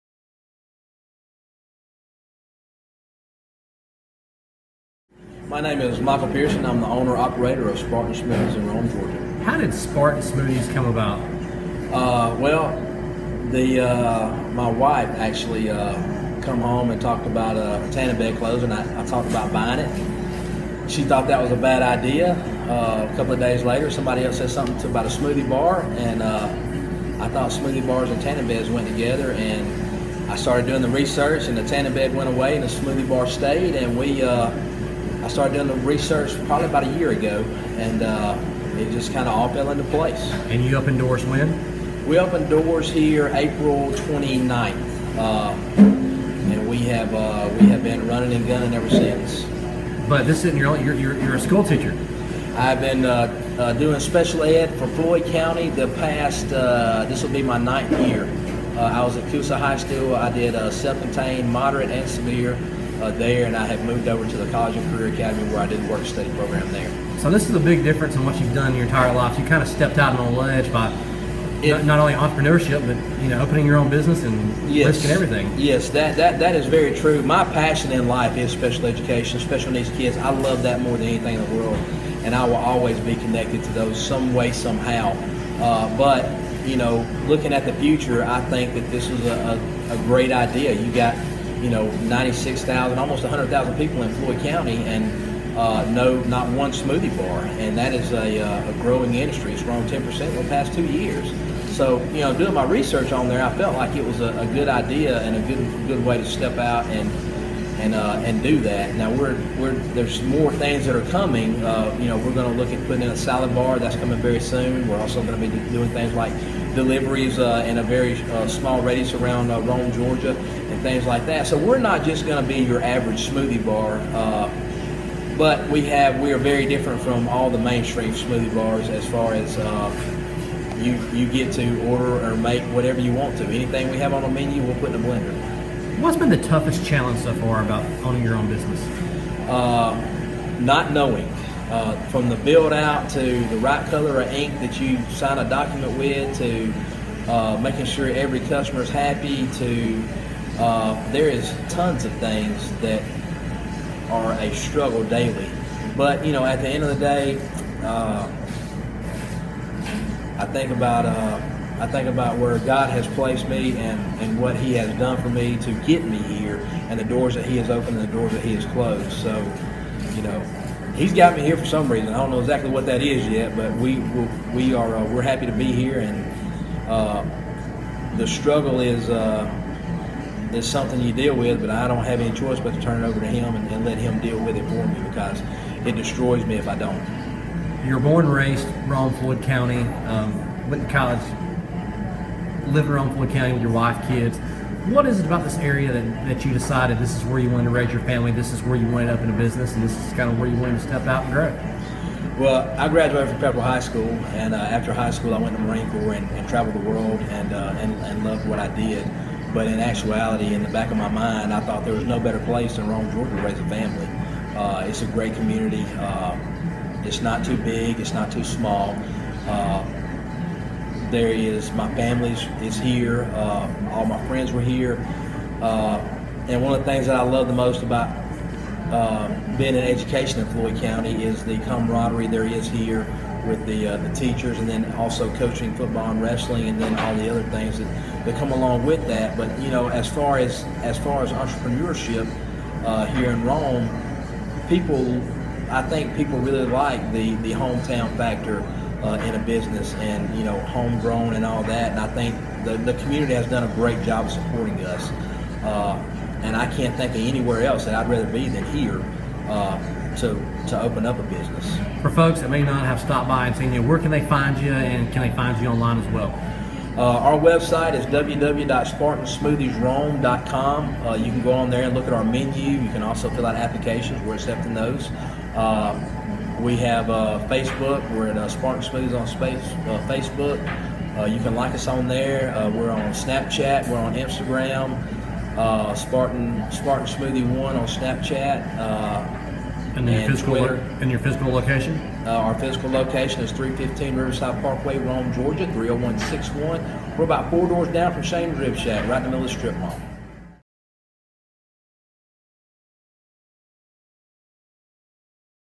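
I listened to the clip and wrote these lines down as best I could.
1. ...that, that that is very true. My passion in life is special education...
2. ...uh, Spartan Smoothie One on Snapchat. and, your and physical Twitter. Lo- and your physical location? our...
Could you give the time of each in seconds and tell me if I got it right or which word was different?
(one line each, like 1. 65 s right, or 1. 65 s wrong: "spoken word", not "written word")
1. 75 s right
2. 286 s right.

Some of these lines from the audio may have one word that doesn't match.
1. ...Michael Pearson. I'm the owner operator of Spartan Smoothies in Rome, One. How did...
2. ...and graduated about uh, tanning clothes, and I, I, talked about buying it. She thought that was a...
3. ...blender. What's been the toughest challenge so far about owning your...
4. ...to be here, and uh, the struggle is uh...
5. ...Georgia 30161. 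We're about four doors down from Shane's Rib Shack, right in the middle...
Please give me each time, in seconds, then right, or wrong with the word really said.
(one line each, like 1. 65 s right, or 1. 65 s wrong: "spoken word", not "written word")
1. 5 s wrong: "Georgia", not "One"
2. 16 s wrong: "talked", not "graduated"
3. 134 s right
4. 175 s right
5. 295 s right.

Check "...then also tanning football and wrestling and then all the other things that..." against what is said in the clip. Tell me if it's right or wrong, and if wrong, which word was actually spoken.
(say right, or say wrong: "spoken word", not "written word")
wrong: "coaching", not "tanning".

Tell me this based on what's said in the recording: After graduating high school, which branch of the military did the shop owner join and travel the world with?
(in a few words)
Marine Corps.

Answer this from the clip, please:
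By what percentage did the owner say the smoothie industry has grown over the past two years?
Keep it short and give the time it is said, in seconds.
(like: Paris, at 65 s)
10 percent, at 99 s.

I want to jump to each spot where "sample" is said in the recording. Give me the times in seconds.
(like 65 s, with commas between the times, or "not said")
not said.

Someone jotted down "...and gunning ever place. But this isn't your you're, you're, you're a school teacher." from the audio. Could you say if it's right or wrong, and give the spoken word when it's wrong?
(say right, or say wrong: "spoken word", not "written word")
wrong: "since", not "place".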